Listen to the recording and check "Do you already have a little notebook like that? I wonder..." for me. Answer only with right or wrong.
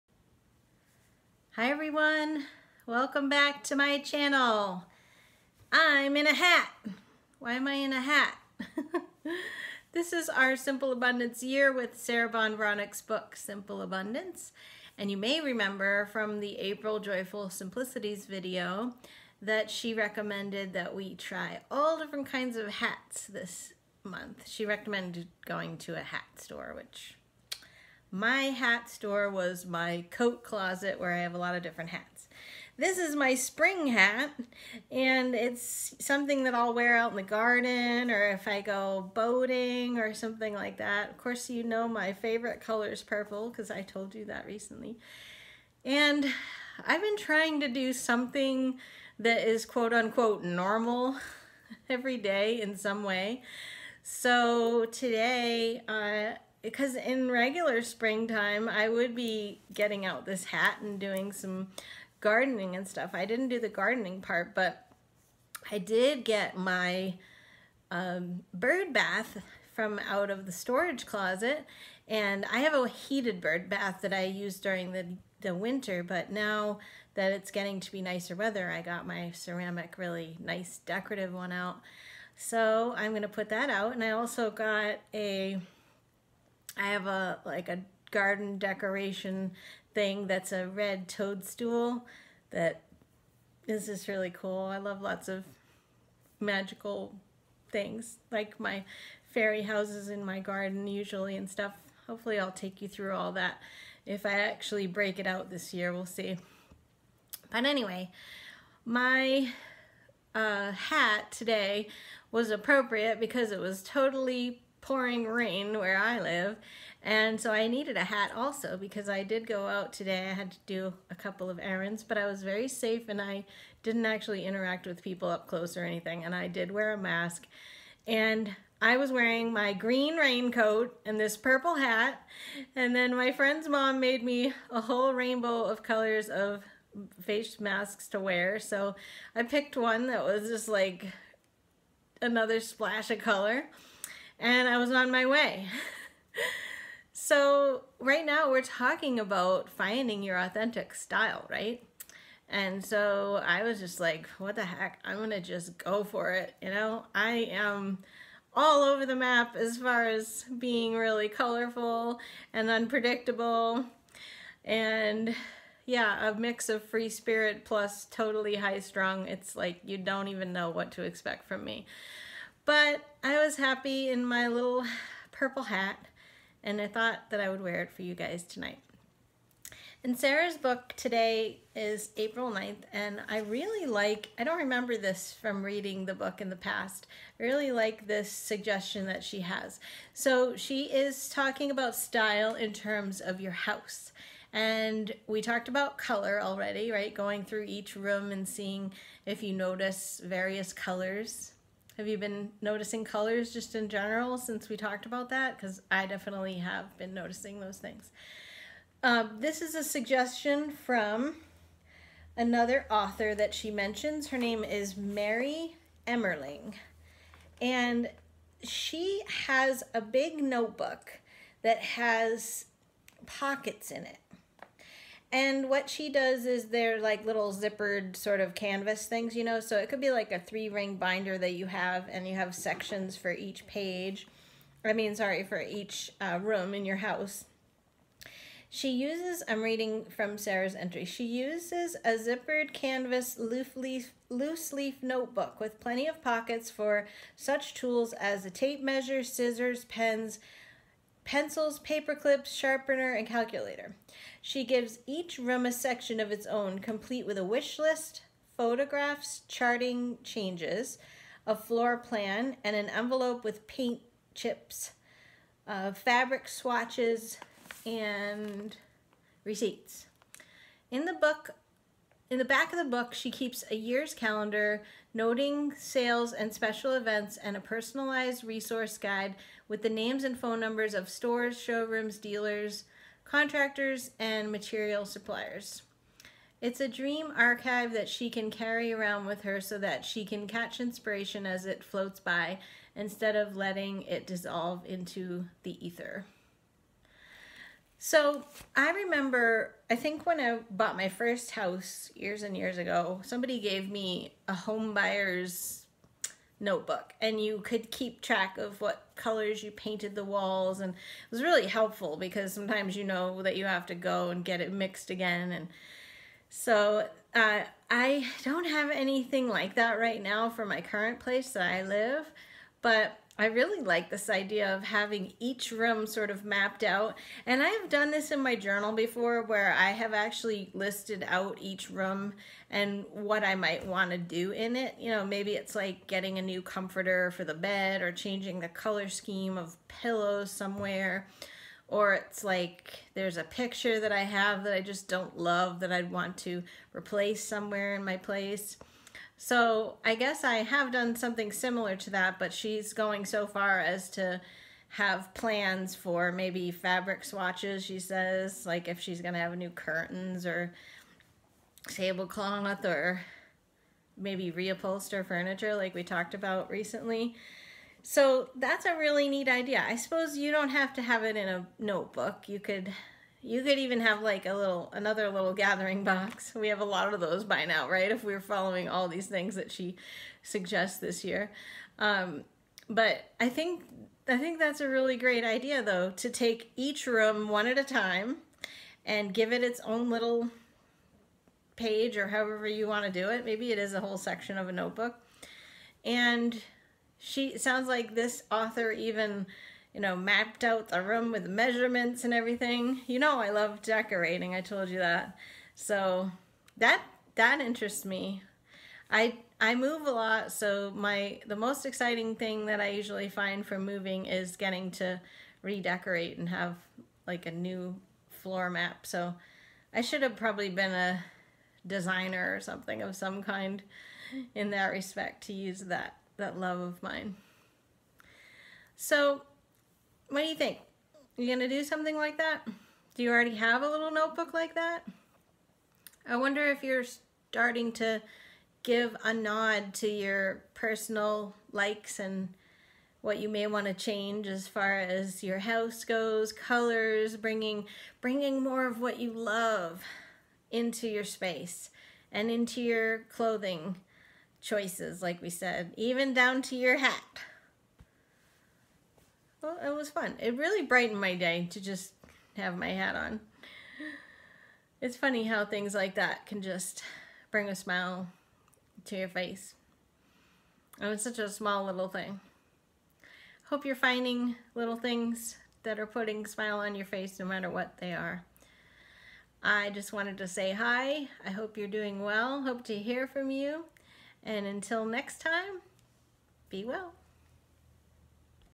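right.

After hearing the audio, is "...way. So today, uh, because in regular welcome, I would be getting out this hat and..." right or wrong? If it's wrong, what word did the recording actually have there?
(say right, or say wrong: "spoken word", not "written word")
wrong: "springtime", not "welcome".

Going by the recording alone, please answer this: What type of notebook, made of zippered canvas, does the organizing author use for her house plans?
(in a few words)
Loose leaf notebook.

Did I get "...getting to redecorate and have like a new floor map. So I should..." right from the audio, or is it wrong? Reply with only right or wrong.
right.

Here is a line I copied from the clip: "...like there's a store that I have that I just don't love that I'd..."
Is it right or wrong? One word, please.
wrong.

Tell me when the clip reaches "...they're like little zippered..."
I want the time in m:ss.
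3:46.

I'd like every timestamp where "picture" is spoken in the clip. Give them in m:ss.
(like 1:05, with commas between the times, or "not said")
5:43.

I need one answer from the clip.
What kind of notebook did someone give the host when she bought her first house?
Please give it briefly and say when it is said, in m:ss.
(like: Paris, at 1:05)
Home buyer's notebook, at 5:04.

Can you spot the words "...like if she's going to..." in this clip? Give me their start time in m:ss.
5:58.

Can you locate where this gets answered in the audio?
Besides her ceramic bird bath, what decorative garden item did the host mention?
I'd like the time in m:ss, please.
1:30.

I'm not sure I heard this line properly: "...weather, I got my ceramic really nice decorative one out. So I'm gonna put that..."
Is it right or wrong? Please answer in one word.
right.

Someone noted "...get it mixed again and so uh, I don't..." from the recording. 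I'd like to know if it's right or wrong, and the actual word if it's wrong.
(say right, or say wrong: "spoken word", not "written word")
right.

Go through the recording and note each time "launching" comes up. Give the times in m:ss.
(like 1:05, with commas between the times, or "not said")
not said.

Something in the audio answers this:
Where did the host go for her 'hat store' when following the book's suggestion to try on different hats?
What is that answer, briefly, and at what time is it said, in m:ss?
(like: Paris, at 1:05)
Coat closet, at 0:29.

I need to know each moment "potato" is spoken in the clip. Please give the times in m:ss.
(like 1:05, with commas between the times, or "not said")
not said.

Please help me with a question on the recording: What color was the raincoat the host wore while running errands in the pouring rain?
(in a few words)
Green.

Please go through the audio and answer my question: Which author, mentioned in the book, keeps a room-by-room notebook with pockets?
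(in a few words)
Mary Emmerling.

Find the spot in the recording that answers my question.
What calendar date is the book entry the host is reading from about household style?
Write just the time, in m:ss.
3:02.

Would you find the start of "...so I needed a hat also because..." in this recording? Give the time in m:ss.
1:57.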